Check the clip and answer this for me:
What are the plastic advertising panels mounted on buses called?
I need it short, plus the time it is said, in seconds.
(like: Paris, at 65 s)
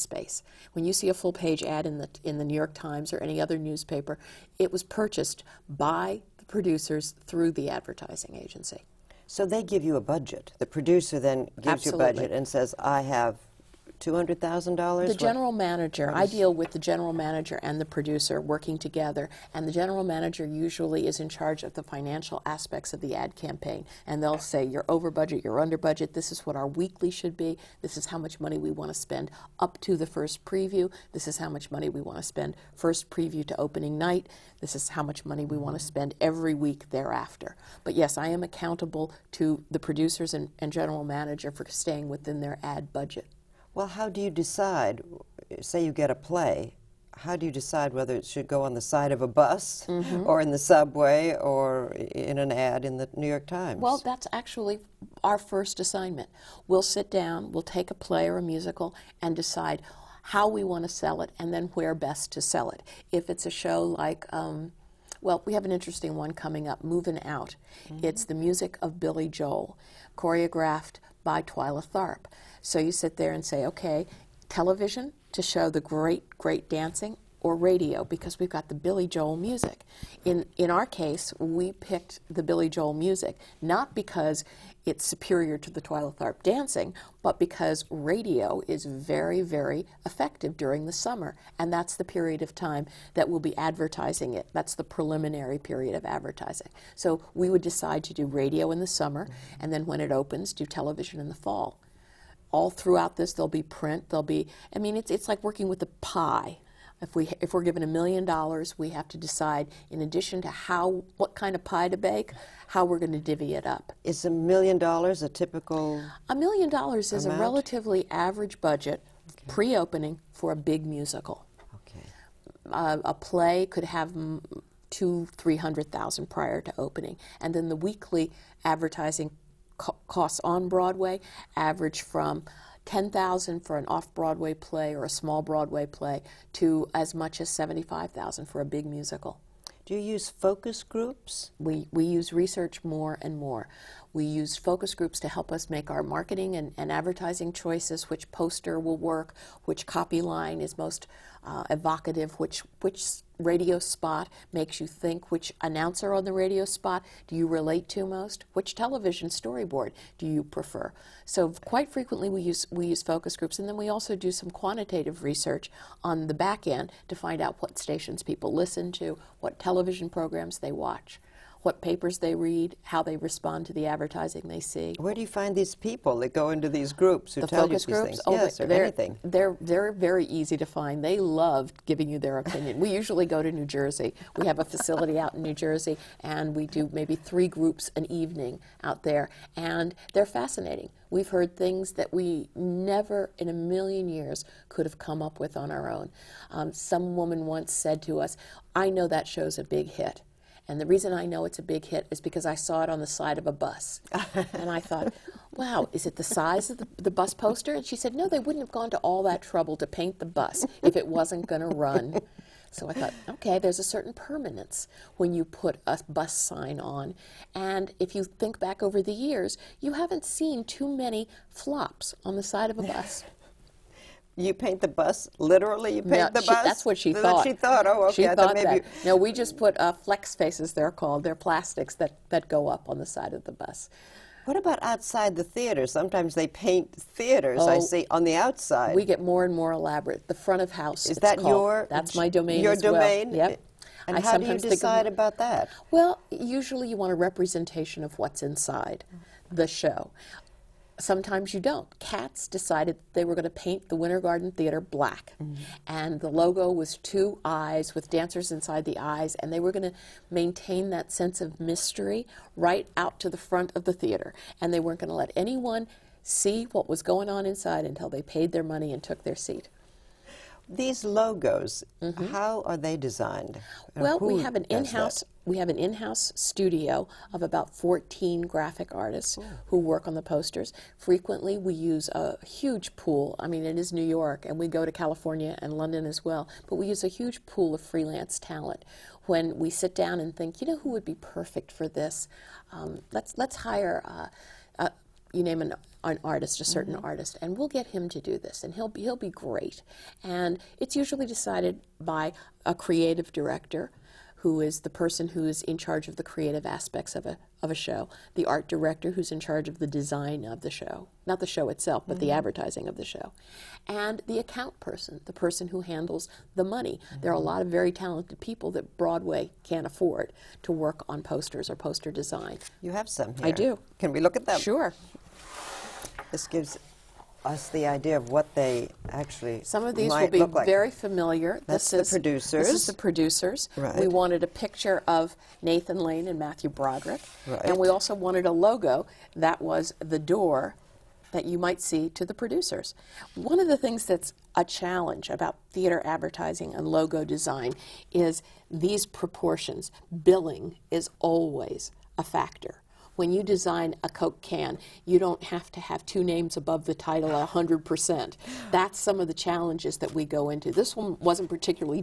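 flex faces, at 229 s.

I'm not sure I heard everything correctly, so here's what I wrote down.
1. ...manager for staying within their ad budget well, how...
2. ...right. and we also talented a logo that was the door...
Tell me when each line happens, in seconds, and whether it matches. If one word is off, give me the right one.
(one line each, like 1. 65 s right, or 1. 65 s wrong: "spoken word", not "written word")
1. 41 s right
2. 337 s wrong: "wanted", not "talented".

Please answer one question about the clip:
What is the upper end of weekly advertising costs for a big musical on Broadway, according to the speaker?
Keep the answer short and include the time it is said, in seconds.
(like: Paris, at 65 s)
$75,000, at 137 s.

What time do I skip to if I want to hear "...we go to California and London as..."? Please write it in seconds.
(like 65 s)
284 s.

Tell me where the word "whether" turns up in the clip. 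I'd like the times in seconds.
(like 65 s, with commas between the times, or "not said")
47 s.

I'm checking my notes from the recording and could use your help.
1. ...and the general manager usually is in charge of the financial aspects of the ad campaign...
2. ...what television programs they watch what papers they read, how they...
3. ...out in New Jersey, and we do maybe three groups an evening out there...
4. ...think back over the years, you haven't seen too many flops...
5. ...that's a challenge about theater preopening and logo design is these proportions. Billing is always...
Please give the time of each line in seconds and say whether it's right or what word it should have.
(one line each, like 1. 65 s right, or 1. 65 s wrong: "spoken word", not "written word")
1. 19 s right
2. 169 s right
3. 185 s right
4. 218 s right
5. 344 s wrong: "advertising", not "preopening".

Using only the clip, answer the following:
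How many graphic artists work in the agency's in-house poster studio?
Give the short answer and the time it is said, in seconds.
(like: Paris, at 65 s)
14, at 277 s.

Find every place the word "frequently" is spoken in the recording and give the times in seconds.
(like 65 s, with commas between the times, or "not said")
161 s, 280 s.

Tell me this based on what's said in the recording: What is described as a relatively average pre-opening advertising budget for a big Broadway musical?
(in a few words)
$1,000,000.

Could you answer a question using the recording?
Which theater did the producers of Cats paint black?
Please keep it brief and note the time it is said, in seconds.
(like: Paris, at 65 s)
Winter Garden Theater, at 253 s.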